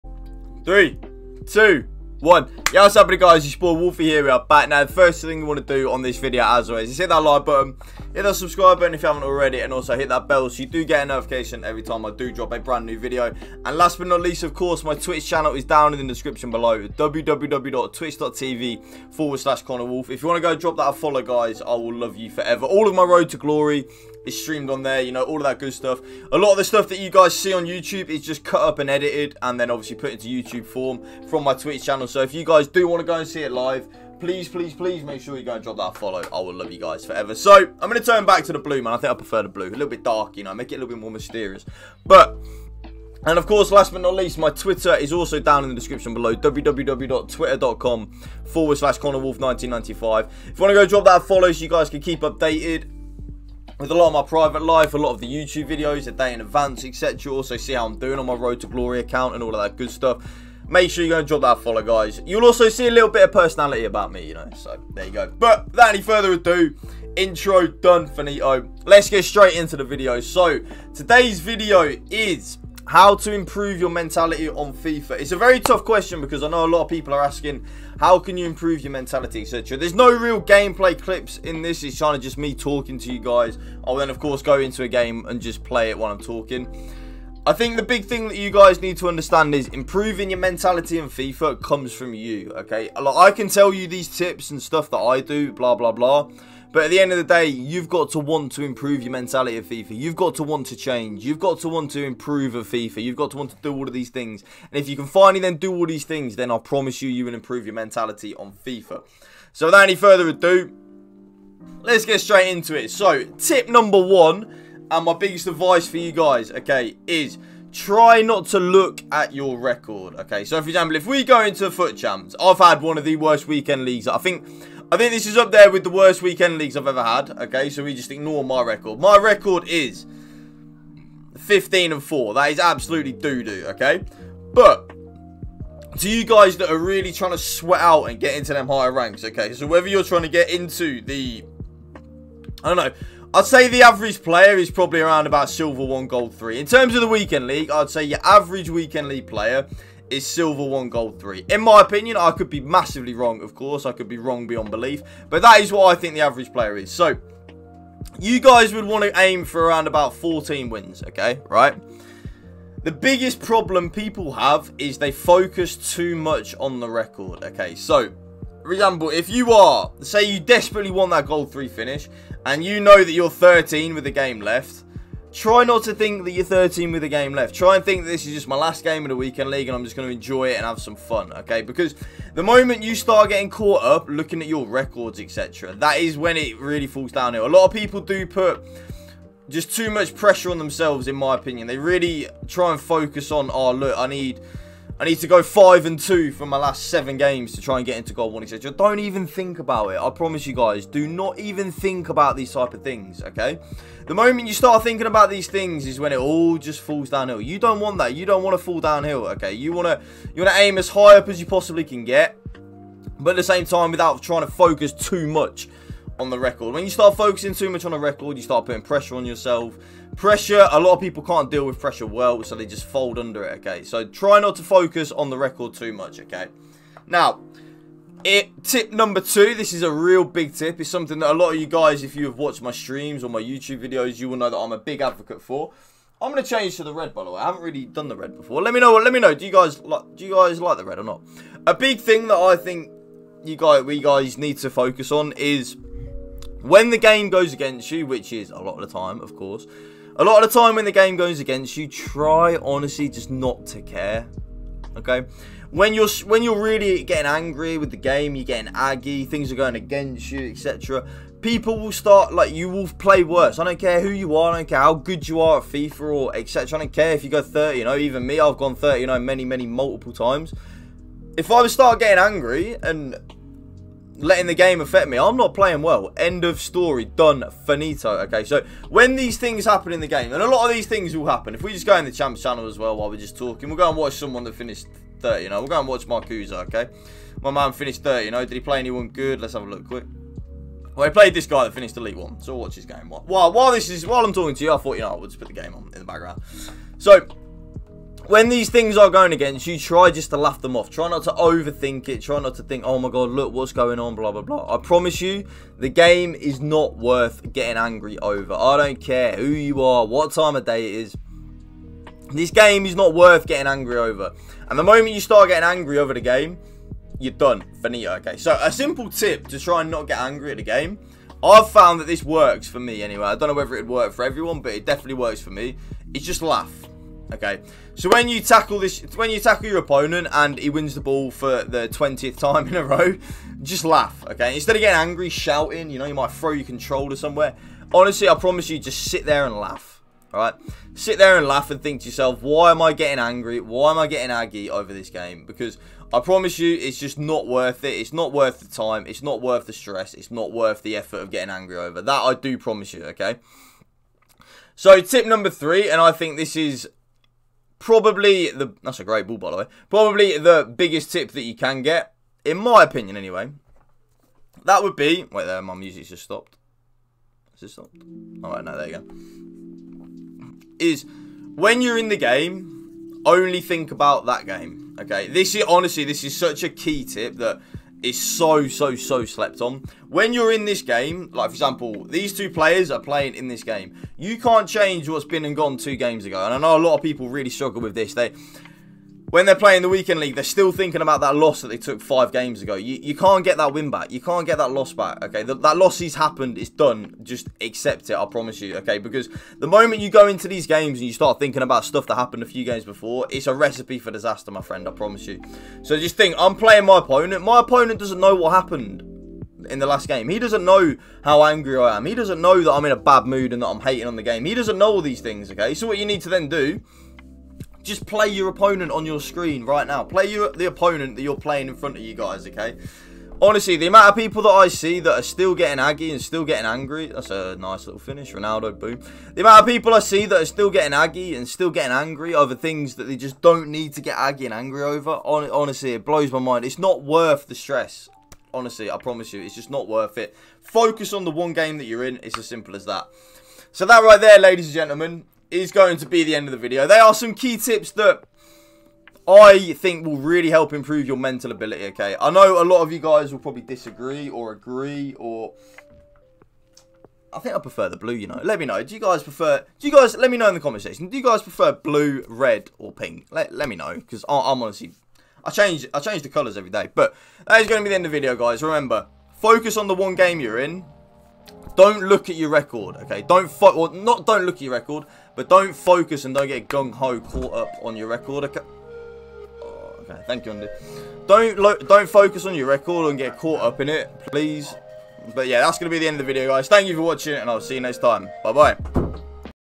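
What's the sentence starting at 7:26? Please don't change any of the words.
They are some key tips that I think will really help improve your mental ability, okay?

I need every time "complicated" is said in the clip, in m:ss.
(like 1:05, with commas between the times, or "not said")
not said.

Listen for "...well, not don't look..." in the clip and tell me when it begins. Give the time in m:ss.
7:53.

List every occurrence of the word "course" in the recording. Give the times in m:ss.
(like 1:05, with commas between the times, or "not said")
0:14, 0:43, 1:24, 2:33, 4:09.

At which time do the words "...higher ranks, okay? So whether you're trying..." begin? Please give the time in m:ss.
2:18.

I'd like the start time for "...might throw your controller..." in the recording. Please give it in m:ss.
5:36.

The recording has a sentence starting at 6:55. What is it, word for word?
Okay, so what you need to then do just play your opponent on your screen right now.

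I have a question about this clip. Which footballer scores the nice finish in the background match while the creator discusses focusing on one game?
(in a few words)
Ronaldo.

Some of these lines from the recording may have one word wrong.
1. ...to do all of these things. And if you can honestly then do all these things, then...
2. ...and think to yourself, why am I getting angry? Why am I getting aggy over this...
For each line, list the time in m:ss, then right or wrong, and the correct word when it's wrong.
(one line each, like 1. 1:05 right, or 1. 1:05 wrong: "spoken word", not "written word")
1. 1:43 wrong: "finally", not "honestly"
2. 5:41 right.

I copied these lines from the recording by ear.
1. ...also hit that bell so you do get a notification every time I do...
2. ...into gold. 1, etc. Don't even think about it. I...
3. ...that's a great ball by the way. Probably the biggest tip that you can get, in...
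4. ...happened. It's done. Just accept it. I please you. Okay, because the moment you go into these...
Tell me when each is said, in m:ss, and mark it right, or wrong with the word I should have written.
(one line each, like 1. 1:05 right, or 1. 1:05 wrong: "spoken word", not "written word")
1. 0:09 right
2. 3:17 right
3. 5:58 right
4. 6:36 wrong: "promise", not "please".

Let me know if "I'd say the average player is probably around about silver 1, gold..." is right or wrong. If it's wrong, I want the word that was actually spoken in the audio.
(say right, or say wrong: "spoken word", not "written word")
right.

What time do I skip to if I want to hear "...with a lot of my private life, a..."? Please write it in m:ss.
0:53.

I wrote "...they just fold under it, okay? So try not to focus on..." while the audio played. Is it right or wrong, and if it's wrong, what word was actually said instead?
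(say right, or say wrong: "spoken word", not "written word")
right.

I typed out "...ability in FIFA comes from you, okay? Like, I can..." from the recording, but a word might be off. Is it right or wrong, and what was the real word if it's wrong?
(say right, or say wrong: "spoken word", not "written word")
wrong: "mentality", not "ability".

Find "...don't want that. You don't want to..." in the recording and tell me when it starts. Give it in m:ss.
3:27.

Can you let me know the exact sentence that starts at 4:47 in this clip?
My man finished 30, you know.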